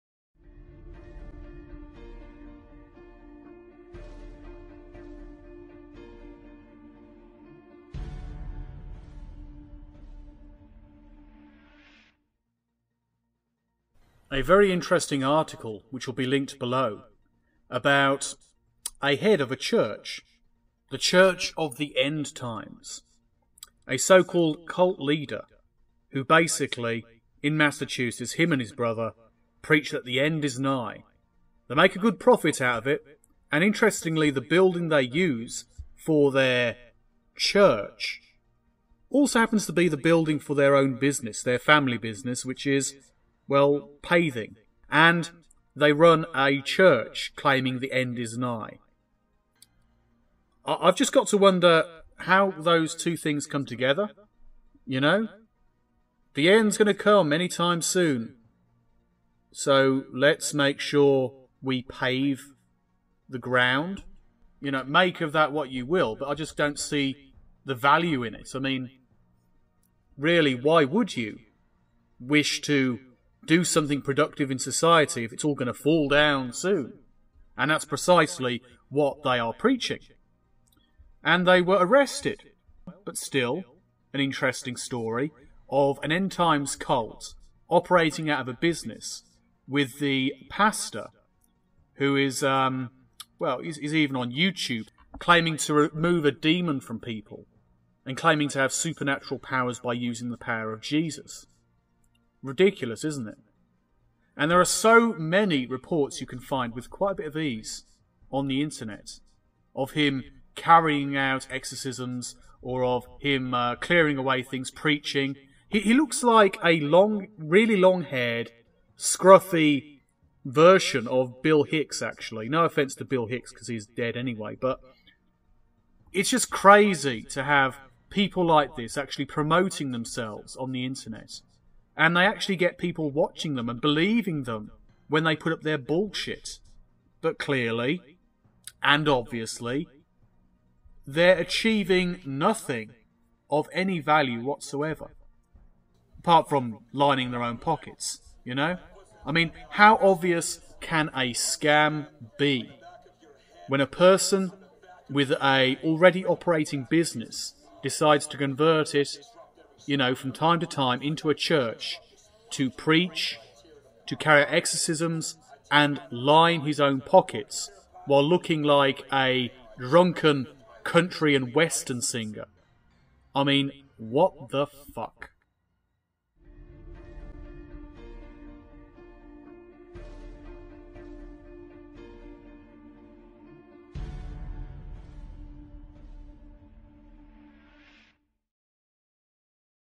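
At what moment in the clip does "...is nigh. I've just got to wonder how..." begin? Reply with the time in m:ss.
0:48.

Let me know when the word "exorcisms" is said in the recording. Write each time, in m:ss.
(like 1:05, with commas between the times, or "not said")
1:51, 2:44.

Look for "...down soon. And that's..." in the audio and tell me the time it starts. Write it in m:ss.
1:16.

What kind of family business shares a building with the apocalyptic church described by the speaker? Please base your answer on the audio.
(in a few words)
Paving.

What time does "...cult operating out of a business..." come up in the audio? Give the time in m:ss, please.
1:26.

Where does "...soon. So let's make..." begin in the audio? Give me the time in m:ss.
0:57.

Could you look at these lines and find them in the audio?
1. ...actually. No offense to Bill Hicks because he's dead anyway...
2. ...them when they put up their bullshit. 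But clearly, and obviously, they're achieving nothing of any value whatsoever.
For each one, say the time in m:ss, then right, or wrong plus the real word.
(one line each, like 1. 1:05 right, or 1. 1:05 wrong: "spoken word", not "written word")
1. 2:02 right
2. 2:14 right.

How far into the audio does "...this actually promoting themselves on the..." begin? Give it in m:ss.
2:08.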